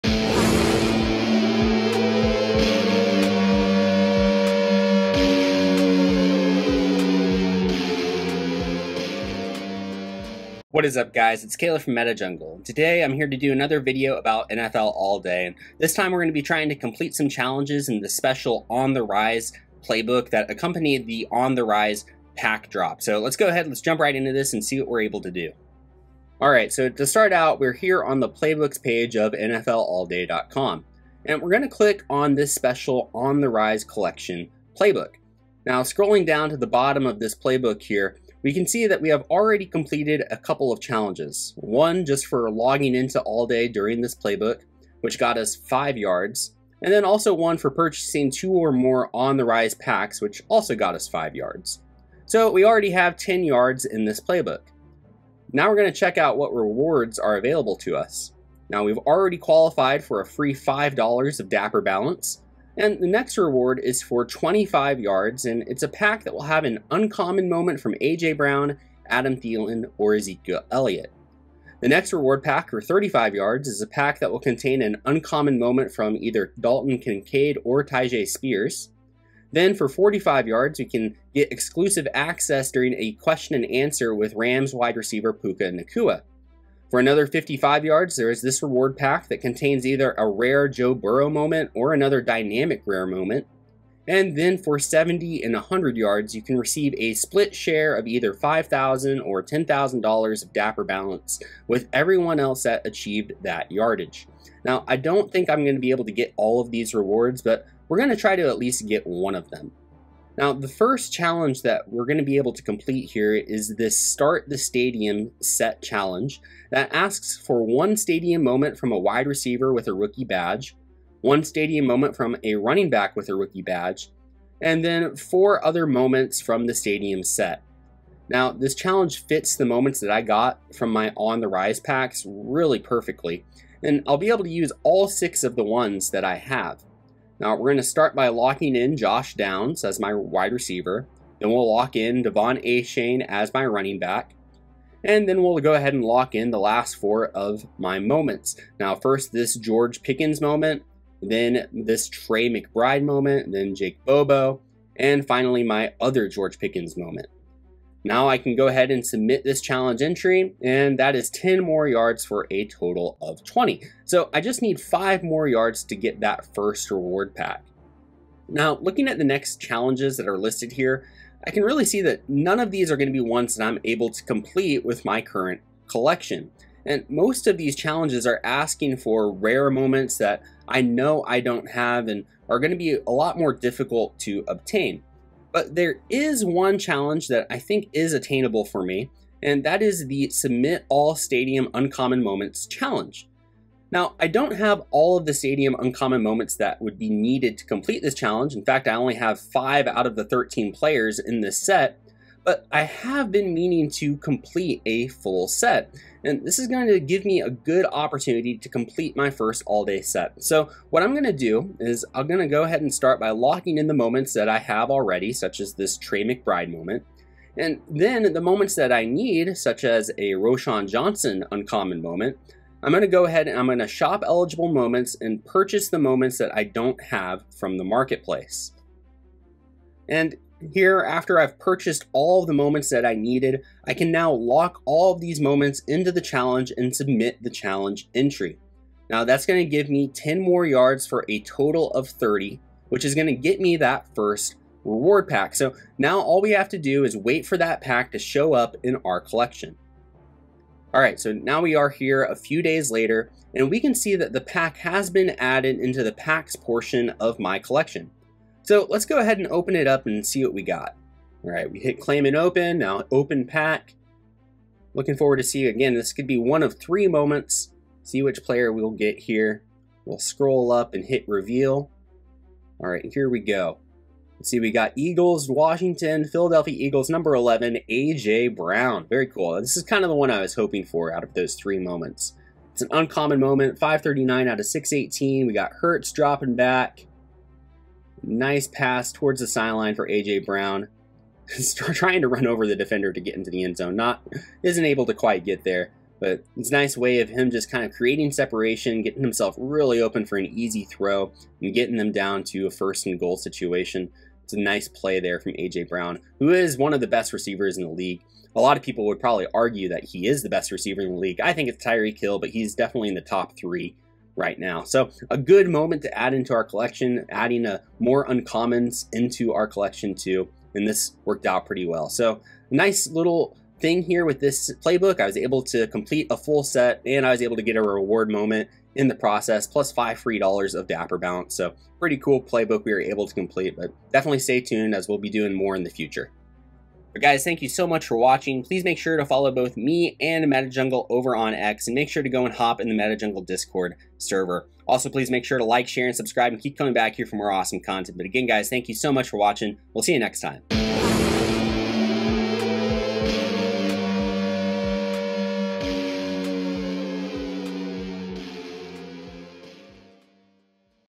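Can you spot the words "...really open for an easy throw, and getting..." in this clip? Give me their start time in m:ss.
4:59.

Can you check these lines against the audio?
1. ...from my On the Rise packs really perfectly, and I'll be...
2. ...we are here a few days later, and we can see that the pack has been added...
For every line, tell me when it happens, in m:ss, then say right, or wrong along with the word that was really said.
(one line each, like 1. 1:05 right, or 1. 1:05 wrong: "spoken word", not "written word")
1. 2:10 right
2. 4:11 right.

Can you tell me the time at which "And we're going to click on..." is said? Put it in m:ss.
0:31.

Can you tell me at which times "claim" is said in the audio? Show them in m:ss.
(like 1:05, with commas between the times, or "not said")
4:21.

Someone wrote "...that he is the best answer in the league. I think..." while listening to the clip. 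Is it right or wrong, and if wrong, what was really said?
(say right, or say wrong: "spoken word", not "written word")
wrong: "receiver", not "answer".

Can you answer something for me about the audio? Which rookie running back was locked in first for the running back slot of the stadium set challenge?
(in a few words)
De'Von Achane.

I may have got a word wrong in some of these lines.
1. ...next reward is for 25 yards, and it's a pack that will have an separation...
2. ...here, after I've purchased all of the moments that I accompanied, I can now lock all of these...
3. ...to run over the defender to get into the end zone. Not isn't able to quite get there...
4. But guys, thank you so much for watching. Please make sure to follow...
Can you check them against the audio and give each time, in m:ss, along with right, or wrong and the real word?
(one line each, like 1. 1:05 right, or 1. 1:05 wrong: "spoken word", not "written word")
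1. 1:03 wrong: "uncommon", not "separation"
2. 3:50 wrong: "needed", not "accompanied"
3. 4:52 right
4. 5:37 right.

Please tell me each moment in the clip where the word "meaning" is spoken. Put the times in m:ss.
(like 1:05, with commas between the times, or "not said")
3:23.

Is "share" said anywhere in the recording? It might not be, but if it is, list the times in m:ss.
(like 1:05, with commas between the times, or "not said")
1:37, 5:45.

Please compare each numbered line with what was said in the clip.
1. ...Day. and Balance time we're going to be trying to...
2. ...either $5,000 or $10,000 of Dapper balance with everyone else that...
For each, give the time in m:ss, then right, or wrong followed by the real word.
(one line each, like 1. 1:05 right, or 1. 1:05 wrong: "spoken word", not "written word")
1. 0:15 wrong: "This", not "Balance"
2. 1:38 right.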